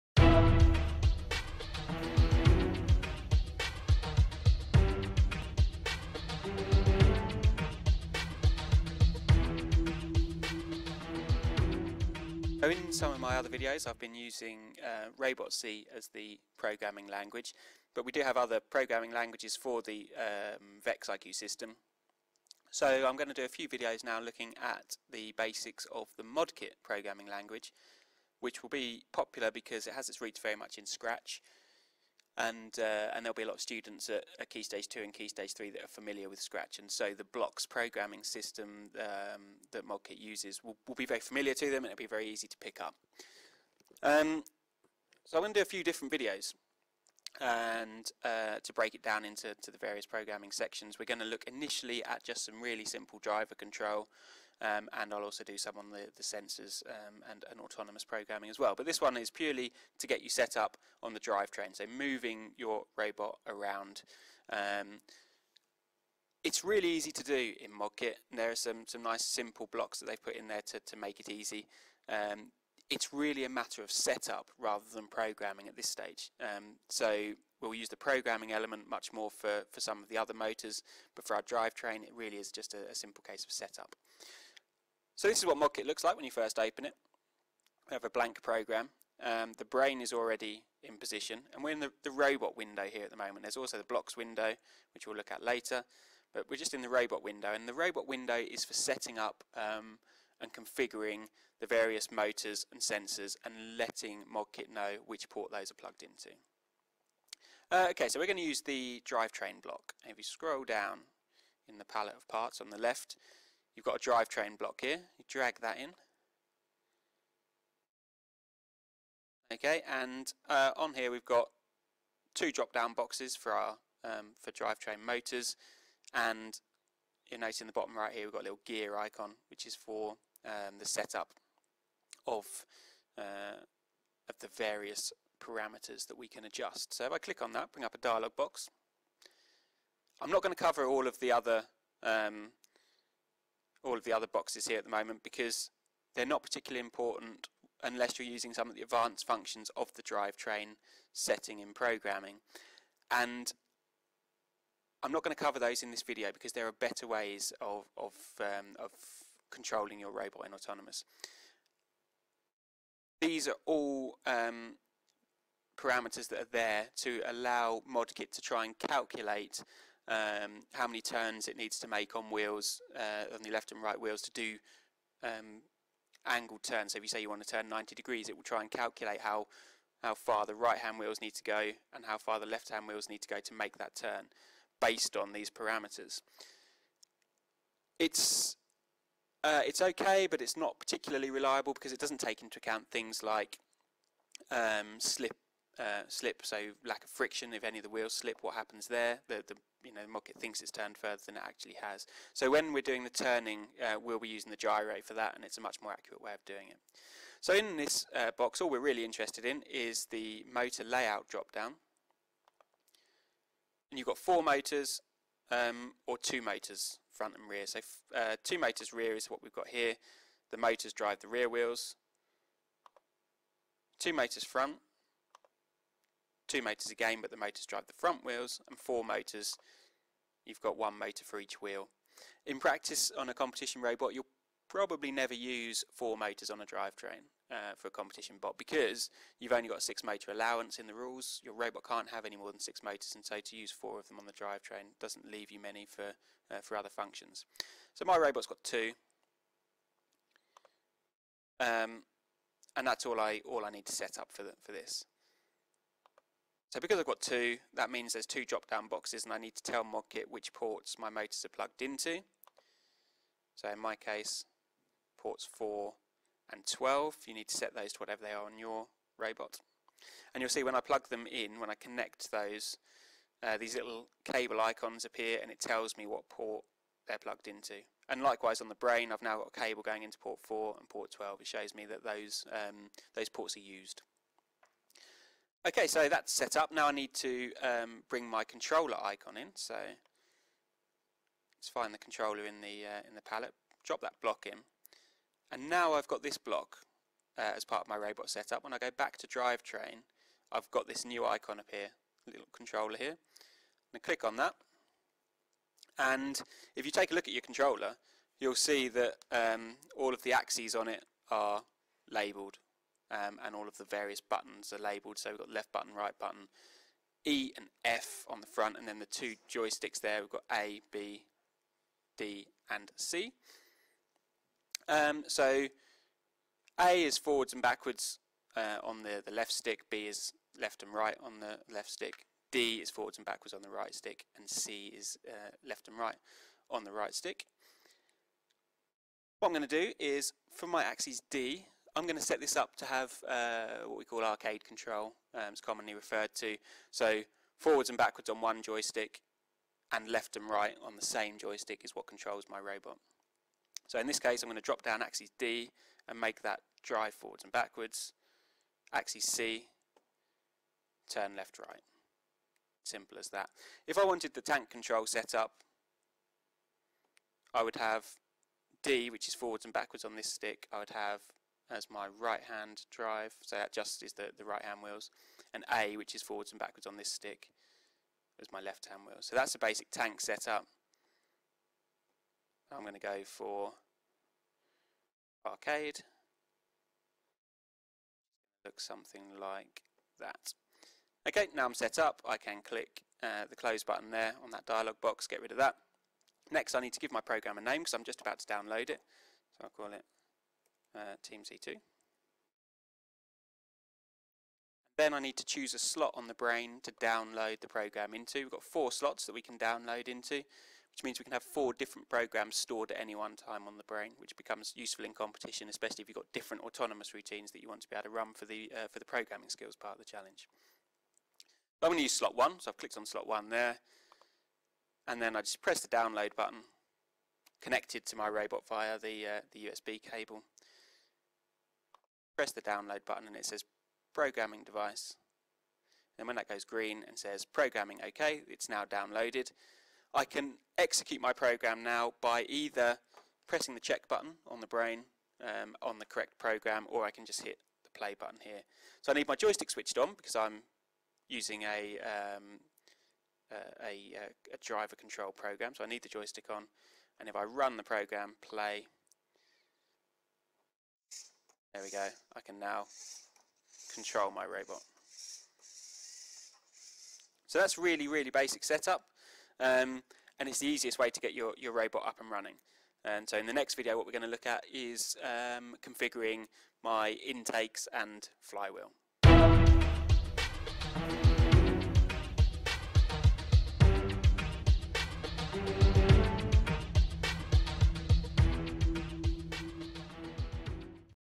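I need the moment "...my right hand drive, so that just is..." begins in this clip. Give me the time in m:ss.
6:11.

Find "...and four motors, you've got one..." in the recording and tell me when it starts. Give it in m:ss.
3:48.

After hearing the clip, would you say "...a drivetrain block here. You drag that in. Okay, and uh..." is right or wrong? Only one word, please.
right.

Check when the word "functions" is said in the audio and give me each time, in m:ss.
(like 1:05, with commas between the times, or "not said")
2:29, 4:06.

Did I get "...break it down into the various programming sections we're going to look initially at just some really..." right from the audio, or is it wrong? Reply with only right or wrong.
right.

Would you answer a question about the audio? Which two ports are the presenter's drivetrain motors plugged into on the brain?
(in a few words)
4 and 12.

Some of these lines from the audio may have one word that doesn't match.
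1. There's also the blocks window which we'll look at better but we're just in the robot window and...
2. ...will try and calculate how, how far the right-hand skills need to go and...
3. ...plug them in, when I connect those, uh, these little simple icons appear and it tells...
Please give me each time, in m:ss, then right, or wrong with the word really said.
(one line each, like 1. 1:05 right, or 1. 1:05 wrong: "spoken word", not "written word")
1. 1:33 wrong: "later", not "better"
2. 2:58 wrong: "wheels", not "skills"
3. 4:30 wrong: "cable", not "simple".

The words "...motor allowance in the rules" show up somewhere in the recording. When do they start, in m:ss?
4:00.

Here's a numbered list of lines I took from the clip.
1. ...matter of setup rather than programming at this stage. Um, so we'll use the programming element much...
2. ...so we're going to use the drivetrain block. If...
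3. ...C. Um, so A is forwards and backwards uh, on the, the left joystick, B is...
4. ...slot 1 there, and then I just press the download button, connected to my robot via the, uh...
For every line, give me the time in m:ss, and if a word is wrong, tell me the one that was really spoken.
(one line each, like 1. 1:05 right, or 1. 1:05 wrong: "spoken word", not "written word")
1. 1:13 right
2. 1:48 right
3. 5:22 wrong: "stick", not "joystick"
4. 7:03 right.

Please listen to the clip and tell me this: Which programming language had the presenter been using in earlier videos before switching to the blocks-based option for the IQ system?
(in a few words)
ROBOTC.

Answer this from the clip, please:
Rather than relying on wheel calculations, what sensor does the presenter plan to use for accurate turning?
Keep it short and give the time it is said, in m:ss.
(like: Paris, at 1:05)
The gyro, at 3:24.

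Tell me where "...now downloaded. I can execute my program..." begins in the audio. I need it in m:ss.
7:18.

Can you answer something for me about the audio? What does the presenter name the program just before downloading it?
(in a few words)
Team C2.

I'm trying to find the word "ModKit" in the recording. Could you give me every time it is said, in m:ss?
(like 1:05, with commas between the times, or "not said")
0:26, 0:39, 1:07, 1:25, 1:44, 2:47, 4:19.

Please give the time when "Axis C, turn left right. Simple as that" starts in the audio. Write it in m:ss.
5:58.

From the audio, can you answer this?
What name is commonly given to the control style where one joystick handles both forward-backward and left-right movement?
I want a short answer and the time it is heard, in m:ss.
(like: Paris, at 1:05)
Arcade control, at 5:44.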